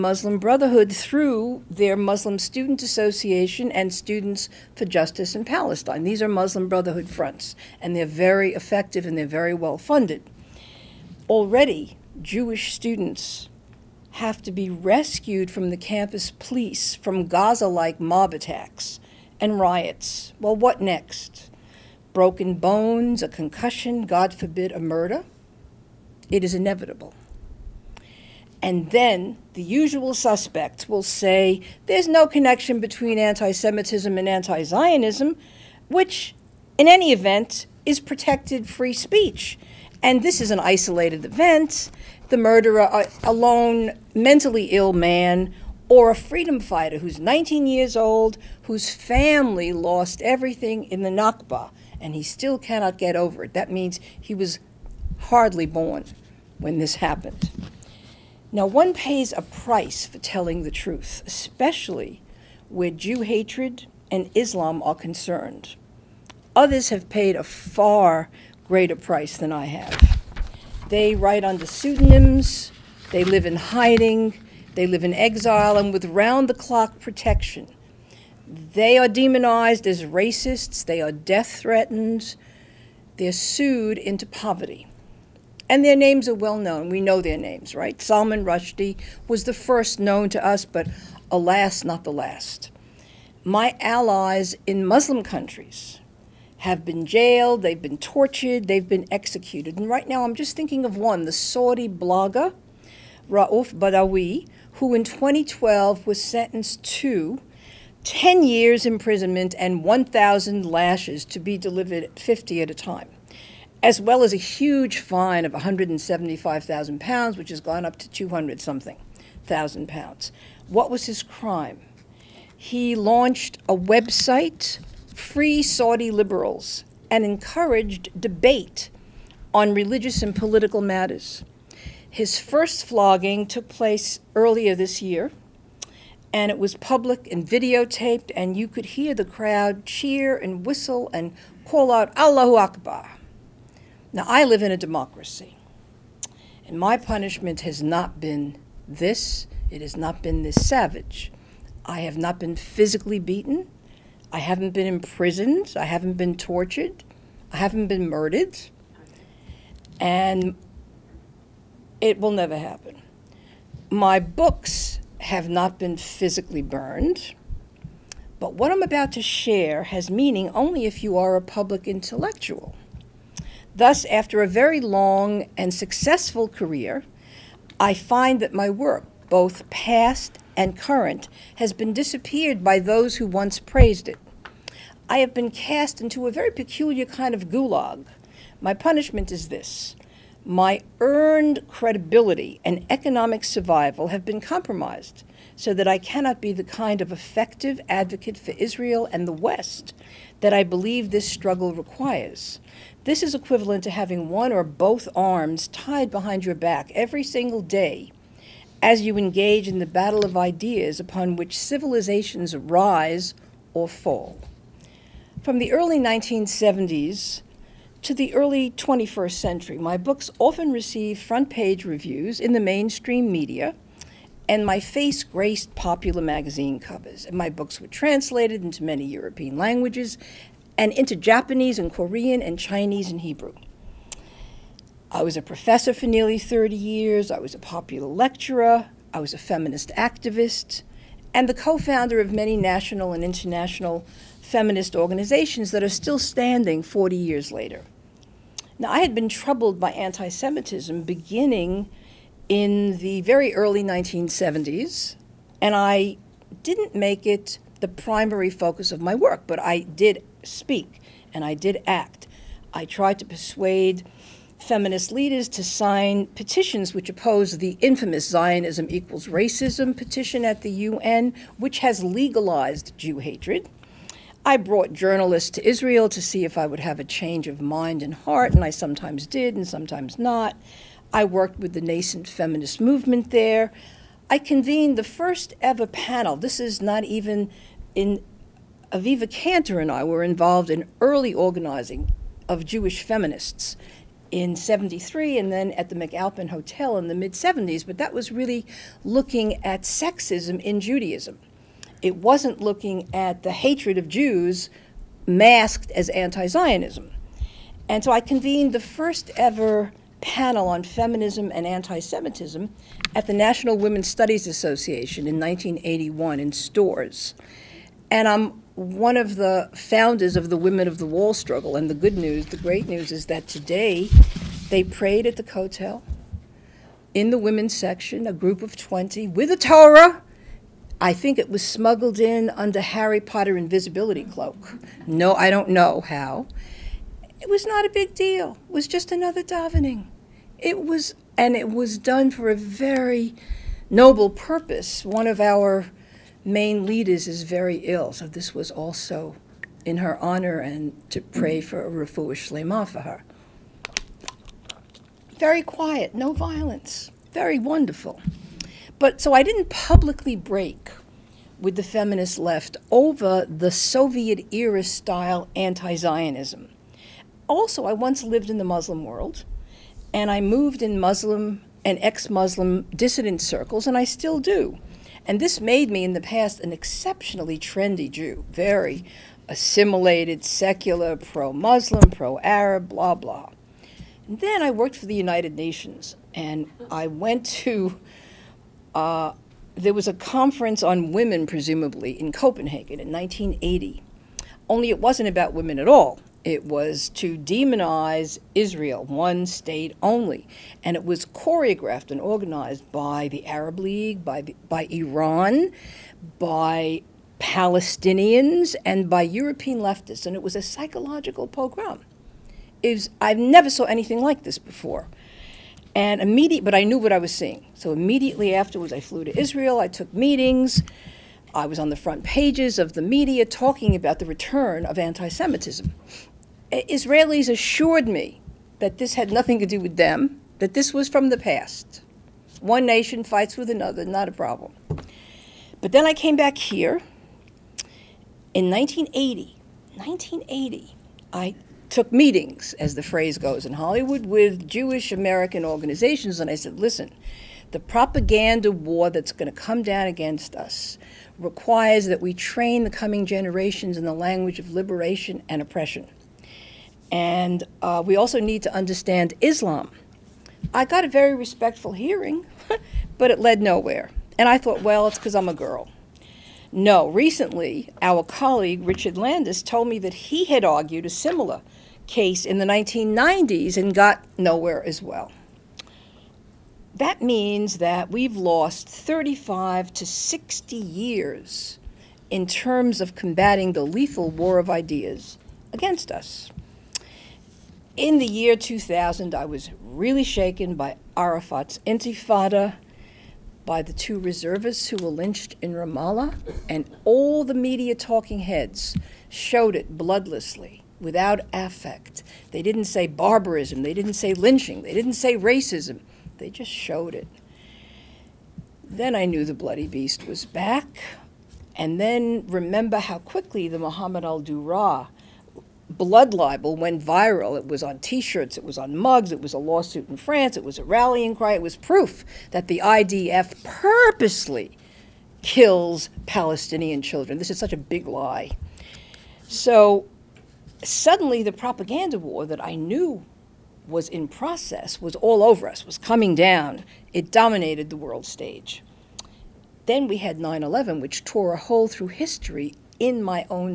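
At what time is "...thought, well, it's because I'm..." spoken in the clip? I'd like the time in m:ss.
7:44.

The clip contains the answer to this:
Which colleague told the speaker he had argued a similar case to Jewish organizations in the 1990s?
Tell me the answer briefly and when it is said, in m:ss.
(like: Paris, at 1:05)
Richard Landes, at 7:48.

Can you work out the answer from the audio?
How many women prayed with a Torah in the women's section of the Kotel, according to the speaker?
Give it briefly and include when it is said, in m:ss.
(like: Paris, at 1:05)
20, at 5:28.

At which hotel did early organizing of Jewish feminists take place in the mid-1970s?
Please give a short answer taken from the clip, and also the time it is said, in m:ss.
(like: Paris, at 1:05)
McAlpin Hotel, at 4:55.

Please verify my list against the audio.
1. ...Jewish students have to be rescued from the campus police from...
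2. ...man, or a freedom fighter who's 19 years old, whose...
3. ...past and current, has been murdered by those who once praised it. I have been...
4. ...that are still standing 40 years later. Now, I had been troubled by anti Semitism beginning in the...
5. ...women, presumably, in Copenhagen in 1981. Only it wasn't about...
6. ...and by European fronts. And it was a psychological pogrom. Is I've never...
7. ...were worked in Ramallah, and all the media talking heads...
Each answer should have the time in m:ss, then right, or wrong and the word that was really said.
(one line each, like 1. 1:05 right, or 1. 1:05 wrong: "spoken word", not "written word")
1. 0:12 right
2. 0:44 right
3. 2:59 wrong: "disappeared", not "murdered"
4. 4:05 right
5. 6:31 wrong: "1980", not "1981"
6. 6:48 wrong: "leftists", not "fronts"
7. 8:14 wrong: "lynched", not "worked".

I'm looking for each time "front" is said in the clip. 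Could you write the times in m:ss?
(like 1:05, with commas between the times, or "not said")
0:07, 3:41, 7:01.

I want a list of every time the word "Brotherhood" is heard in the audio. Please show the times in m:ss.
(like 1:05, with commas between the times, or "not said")
0:00, 0:06.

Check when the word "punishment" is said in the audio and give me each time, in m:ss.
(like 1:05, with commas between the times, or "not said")
2:26, 3:08.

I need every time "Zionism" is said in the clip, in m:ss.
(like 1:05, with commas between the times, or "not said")
0:34, 4:28, 5:06, 6:05.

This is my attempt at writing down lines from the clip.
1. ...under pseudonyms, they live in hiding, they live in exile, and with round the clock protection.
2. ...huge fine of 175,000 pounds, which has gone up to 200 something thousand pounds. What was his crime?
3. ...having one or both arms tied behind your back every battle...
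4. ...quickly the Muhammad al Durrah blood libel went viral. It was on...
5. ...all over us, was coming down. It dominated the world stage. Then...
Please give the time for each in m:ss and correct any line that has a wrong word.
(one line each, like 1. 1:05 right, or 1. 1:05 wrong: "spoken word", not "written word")
1. 1:11 right
2. 1:54 right
3. 3:23 wrong: "single", not "battle"
4. 8:33 right
5. 8:55 right.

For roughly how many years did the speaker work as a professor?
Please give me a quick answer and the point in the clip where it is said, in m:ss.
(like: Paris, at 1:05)
nearly 30, at 3:56.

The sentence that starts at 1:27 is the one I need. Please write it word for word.
Salman Rushdie was the first known to us, but alas, not the last.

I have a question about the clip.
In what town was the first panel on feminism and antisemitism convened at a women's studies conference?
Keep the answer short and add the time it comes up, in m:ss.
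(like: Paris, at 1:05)
Storrs, at 5:16.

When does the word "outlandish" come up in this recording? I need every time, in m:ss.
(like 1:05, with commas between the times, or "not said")
not said.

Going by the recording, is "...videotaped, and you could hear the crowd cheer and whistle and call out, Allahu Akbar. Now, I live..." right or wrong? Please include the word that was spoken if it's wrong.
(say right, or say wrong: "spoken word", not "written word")
right.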